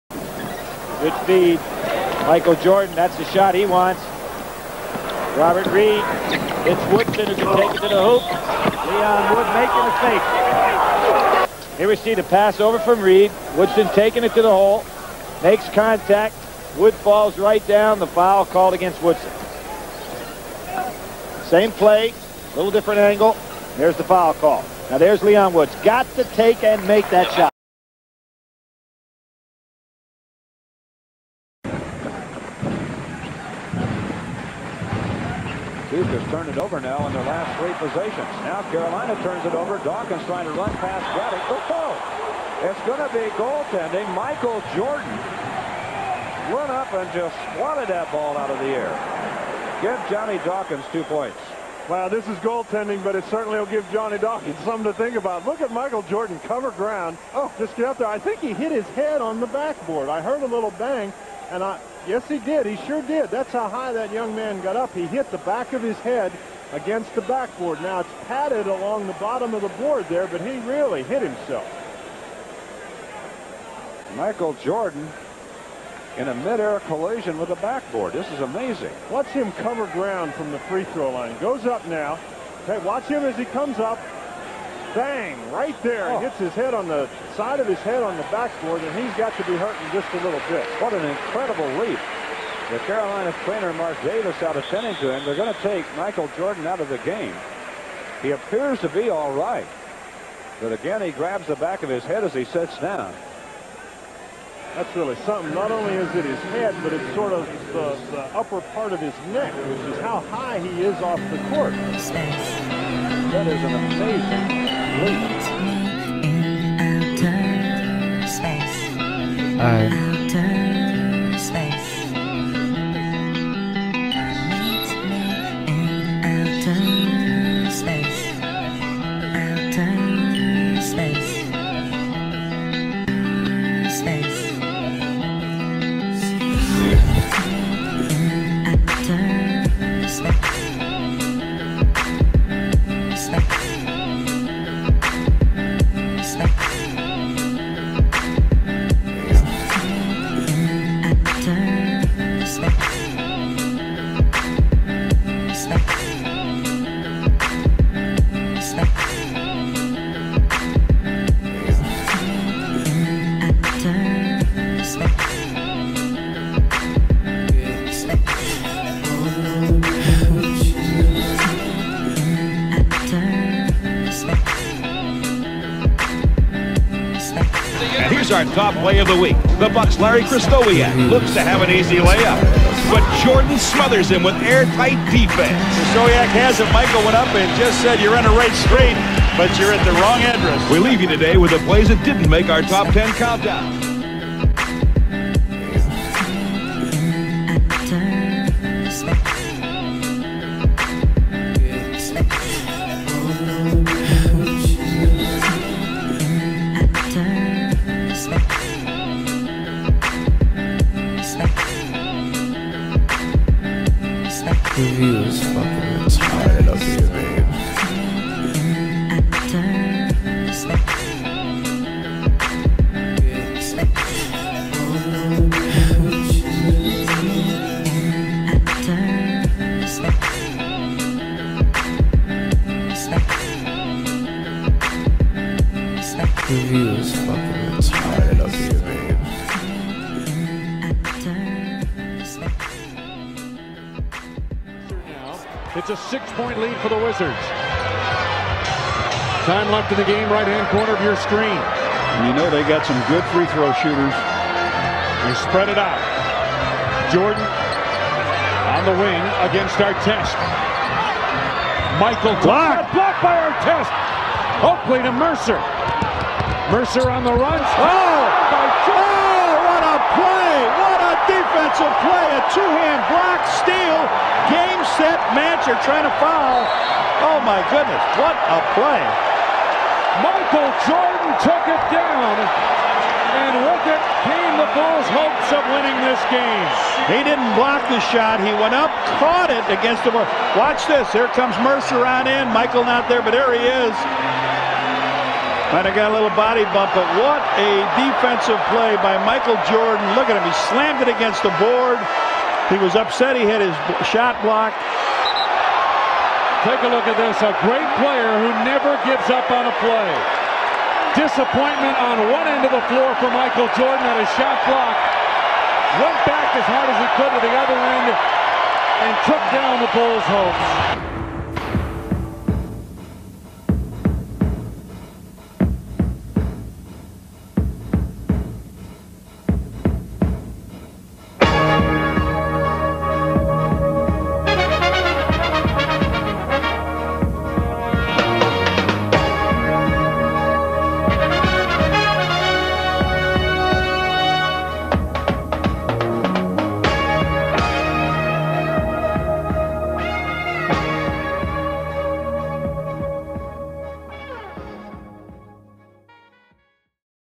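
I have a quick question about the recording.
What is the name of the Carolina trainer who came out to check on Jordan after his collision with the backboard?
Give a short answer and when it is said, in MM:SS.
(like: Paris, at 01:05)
Mark Davis, at 01:33.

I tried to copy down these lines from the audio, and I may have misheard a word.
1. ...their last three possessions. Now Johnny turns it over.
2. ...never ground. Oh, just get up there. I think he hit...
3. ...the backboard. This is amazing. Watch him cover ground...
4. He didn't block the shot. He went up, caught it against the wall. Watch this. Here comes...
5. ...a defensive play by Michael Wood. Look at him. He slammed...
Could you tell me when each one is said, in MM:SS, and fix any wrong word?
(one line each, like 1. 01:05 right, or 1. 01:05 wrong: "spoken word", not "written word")
1. 00:37 wrong: "Carolina", not "Johnny"
2. 00:56 wrong: "cover", not "never"
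3. 01:17 right
4. 04:47 right
5. 04:57 wrong: "Jordan", not "Wood".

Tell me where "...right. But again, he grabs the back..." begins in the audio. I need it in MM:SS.
01:39.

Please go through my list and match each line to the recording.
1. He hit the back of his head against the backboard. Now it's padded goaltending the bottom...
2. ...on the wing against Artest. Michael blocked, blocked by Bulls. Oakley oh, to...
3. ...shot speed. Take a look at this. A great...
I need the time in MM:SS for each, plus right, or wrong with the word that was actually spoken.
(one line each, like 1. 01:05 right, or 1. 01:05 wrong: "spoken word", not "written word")
1. 01:04 wrong: "along", not "goaltending"
2. 04:18 wrong: "Artest", not "Bulls"
3. 05:04 wrong: "blocked", not "speed".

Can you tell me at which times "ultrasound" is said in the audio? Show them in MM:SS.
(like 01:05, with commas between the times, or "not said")
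not said.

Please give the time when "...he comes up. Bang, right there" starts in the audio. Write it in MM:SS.
01:23.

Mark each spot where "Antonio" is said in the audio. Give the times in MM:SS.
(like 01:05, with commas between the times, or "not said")
01:34.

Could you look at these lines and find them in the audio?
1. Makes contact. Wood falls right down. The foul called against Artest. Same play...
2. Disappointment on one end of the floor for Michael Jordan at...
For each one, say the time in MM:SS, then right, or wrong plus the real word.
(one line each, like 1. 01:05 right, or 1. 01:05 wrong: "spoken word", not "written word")
1. 00:15 wrong: "Woodson", not "Artest"
2. 05:11 right.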